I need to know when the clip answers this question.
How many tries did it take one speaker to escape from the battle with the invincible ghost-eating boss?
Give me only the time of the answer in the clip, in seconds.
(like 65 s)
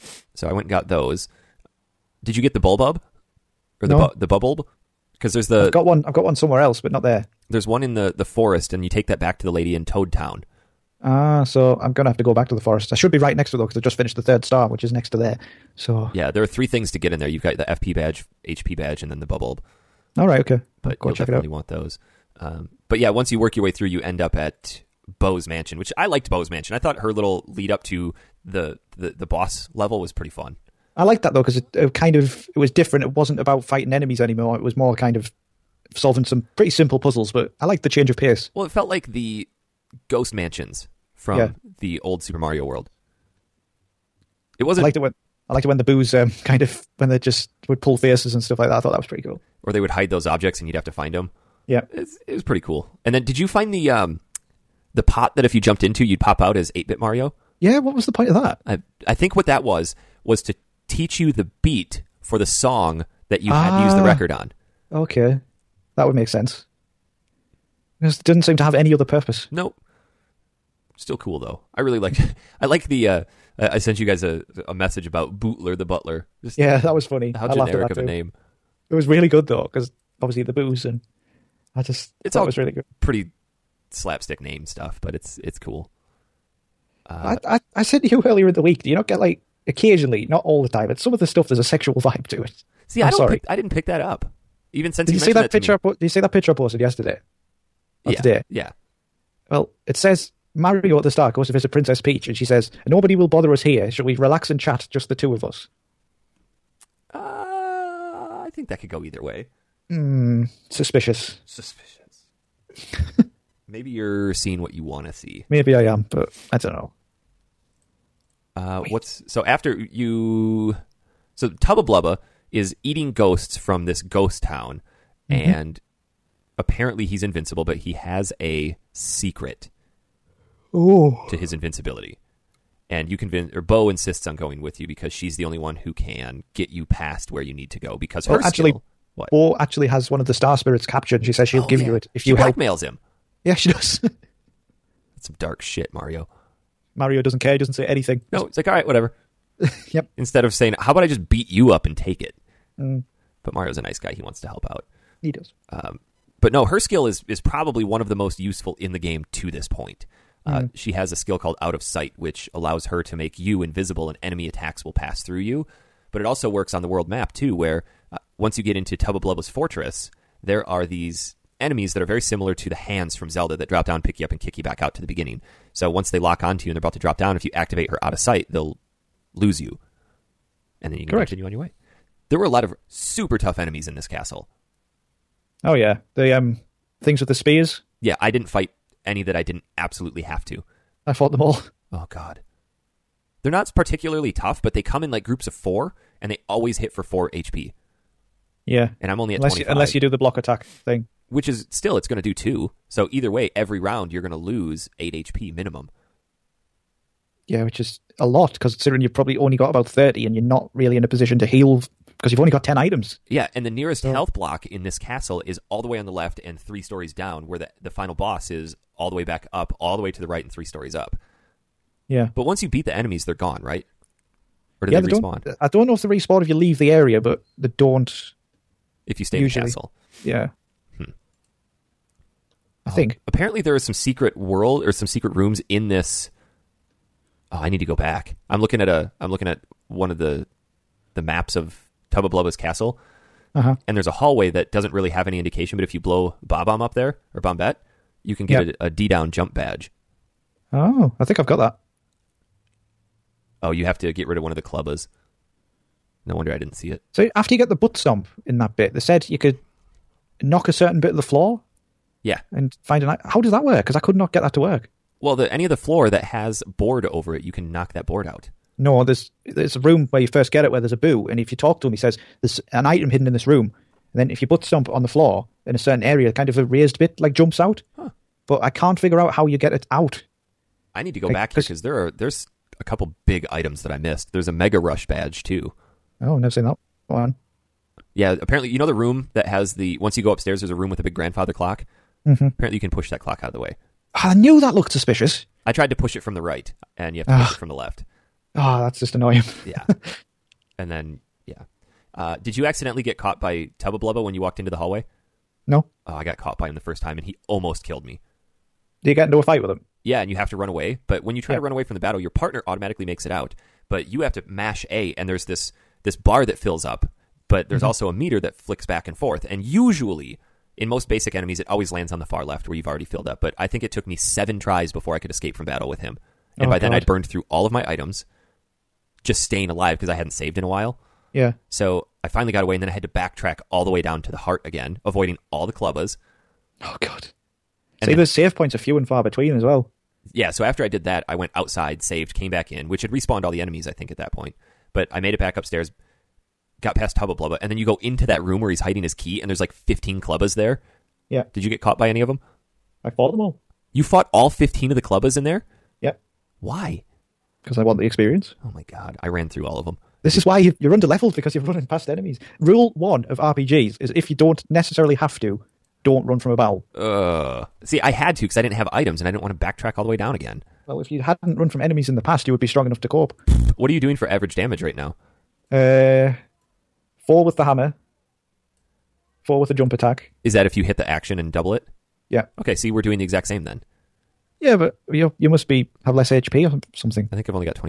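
324 s.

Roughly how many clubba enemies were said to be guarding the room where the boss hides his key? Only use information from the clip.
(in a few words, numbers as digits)
15.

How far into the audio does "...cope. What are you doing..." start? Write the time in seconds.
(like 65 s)
373 s.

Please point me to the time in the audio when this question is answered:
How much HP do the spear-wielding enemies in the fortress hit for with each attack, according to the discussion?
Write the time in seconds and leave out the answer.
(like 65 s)
197 s.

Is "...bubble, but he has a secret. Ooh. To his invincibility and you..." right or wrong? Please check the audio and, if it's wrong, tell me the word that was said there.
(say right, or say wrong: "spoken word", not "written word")
wrong: "invincible", not "bubble".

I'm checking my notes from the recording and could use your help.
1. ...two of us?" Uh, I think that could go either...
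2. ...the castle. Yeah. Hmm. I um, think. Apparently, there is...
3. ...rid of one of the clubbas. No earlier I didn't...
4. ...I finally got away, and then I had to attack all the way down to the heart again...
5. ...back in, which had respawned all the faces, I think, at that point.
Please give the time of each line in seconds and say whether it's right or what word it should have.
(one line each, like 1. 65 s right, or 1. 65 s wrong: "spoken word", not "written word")
1. 105 s right
2. 229 s right
3. 254 s wrong: "wonder", not "earlier"
4. 332 s wrong: "backtrack", not "attack"
5. 342 s wrong: "enemies", not "faces".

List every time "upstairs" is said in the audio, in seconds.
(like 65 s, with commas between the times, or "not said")
290 s, 345 s.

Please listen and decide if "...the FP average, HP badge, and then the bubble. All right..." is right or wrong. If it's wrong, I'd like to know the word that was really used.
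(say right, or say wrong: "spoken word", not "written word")
wrong: "badge", not "average".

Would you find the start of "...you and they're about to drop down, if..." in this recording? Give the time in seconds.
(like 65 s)
176 s.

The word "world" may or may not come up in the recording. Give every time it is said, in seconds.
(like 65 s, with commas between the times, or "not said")
42 s, 166 s, 234 s.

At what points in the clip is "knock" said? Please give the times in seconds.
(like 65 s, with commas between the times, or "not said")
260 s, 267 s.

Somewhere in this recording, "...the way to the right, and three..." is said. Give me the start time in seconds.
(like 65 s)
219 s.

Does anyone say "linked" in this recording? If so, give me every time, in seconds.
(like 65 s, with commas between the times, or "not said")
not said.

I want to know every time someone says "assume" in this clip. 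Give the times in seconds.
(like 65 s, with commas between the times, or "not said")
not said.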